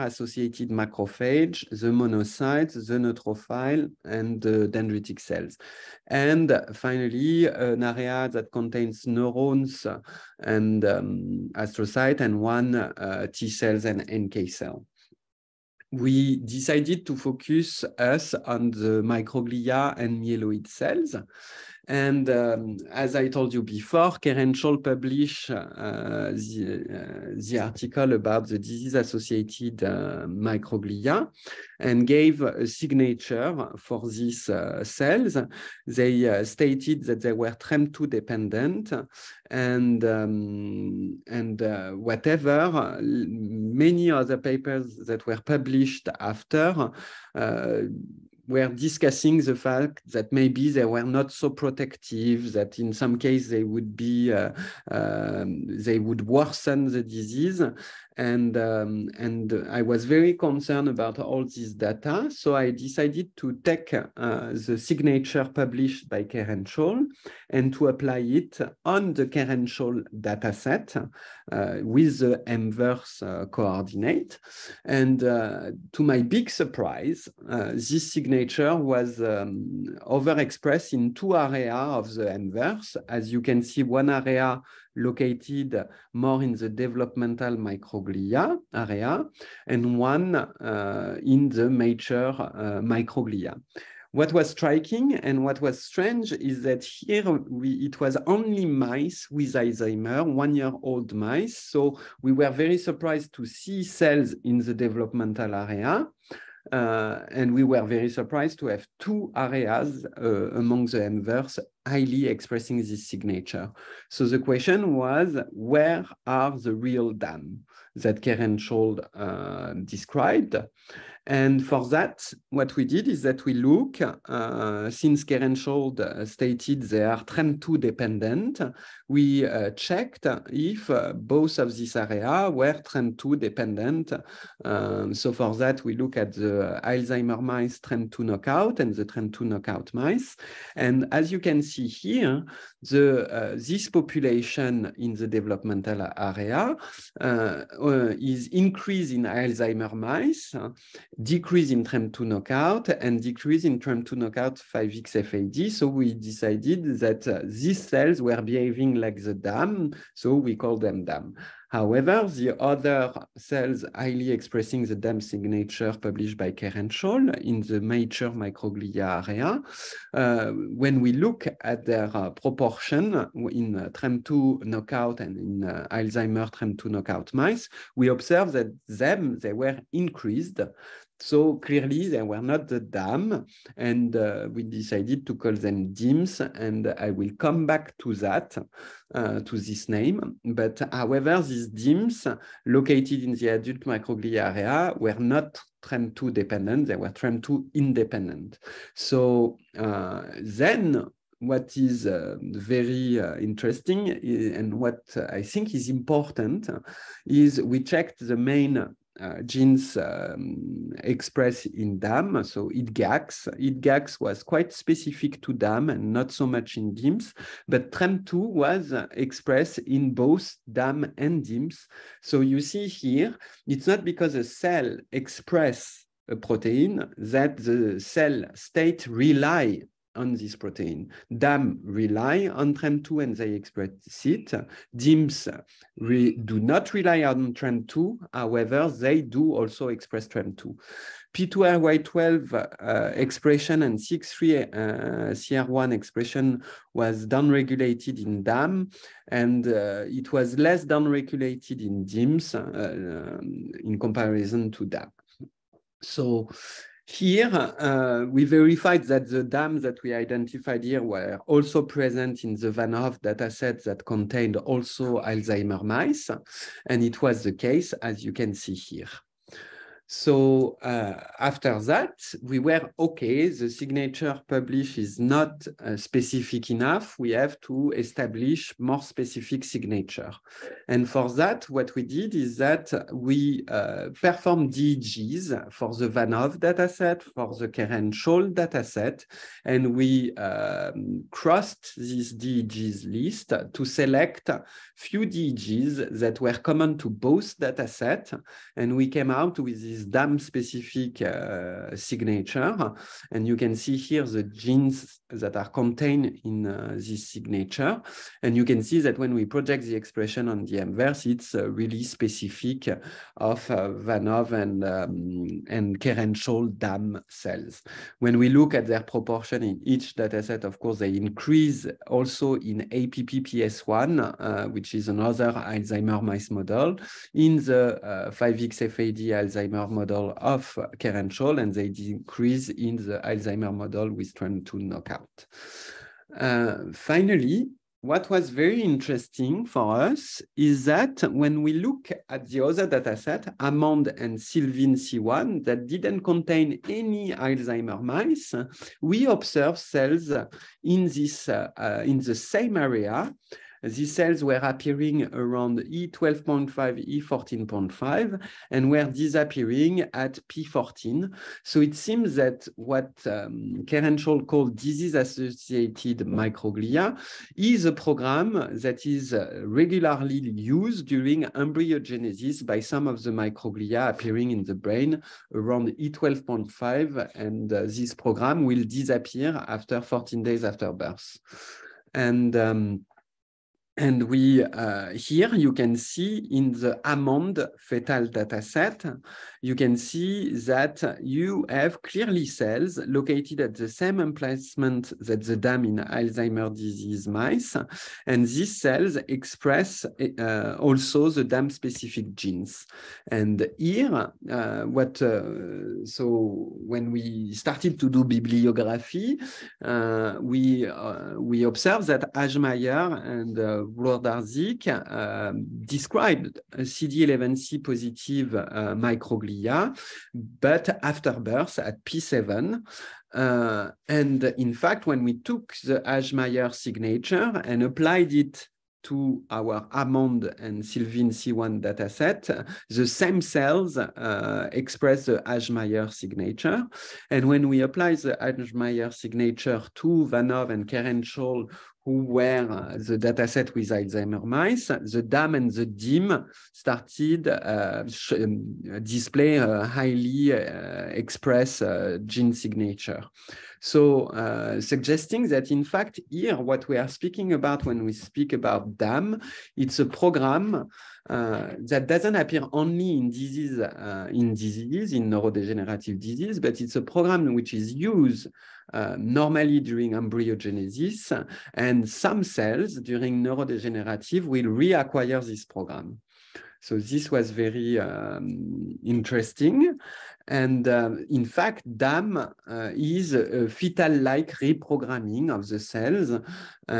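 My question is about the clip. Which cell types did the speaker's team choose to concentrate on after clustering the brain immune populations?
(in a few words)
Microglia and myeloid cells.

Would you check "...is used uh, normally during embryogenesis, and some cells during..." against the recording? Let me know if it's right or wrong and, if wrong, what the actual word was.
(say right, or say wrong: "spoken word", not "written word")
right.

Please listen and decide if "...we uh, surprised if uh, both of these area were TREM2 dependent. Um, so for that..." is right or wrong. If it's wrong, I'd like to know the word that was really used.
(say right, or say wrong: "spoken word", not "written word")
wrong: "checked", not "surprised".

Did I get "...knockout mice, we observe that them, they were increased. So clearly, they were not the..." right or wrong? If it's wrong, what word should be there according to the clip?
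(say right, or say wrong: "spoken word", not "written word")
right.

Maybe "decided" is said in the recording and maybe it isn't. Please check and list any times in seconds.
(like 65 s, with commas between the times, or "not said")
16 s, 62 s, 156 s, 184 s.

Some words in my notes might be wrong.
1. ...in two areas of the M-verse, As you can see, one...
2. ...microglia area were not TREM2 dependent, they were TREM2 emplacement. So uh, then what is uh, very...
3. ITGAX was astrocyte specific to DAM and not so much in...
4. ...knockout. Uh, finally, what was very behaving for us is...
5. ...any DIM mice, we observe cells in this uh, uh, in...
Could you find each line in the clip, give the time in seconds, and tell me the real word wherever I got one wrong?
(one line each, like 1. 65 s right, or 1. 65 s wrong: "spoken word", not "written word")
1. 80 s right
2. 193 s wrong: "independent", not "emplacement"
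3. 213 s wrong: "quite", not "astrocyte"
4. 334 s wrong: "interesting", not "behaving"
5. 346 s wrong: "Alzheimer", not "DIM".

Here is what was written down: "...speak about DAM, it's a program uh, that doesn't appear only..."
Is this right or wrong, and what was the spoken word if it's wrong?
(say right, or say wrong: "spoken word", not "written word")
right.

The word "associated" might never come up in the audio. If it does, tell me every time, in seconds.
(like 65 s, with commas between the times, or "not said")
28 s, 364 s.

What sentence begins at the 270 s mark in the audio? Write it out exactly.
So uh, after that, we were okay, the signature publish is not uh, specific enough.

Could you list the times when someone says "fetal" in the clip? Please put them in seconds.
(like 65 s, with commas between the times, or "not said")
387 s, 483 s.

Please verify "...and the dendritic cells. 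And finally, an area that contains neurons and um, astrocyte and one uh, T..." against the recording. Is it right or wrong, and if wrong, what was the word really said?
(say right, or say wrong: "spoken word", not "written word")
right.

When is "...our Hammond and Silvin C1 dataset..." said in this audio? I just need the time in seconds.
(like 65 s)
429 s.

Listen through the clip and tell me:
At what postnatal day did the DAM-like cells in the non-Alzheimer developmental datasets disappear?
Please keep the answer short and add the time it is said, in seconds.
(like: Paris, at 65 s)
P14, at 360 s.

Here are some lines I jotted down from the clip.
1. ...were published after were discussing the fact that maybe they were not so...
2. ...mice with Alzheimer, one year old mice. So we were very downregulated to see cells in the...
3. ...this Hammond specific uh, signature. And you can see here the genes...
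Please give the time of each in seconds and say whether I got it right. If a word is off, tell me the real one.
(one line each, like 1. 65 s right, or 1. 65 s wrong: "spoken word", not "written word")
1. 45 s right
2. 98 s wrong: "surprised", not "downregulated"
3. 299 s wrong: "DAM", not "Hammond".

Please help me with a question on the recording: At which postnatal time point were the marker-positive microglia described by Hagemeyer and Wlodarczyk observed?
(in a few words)
P7.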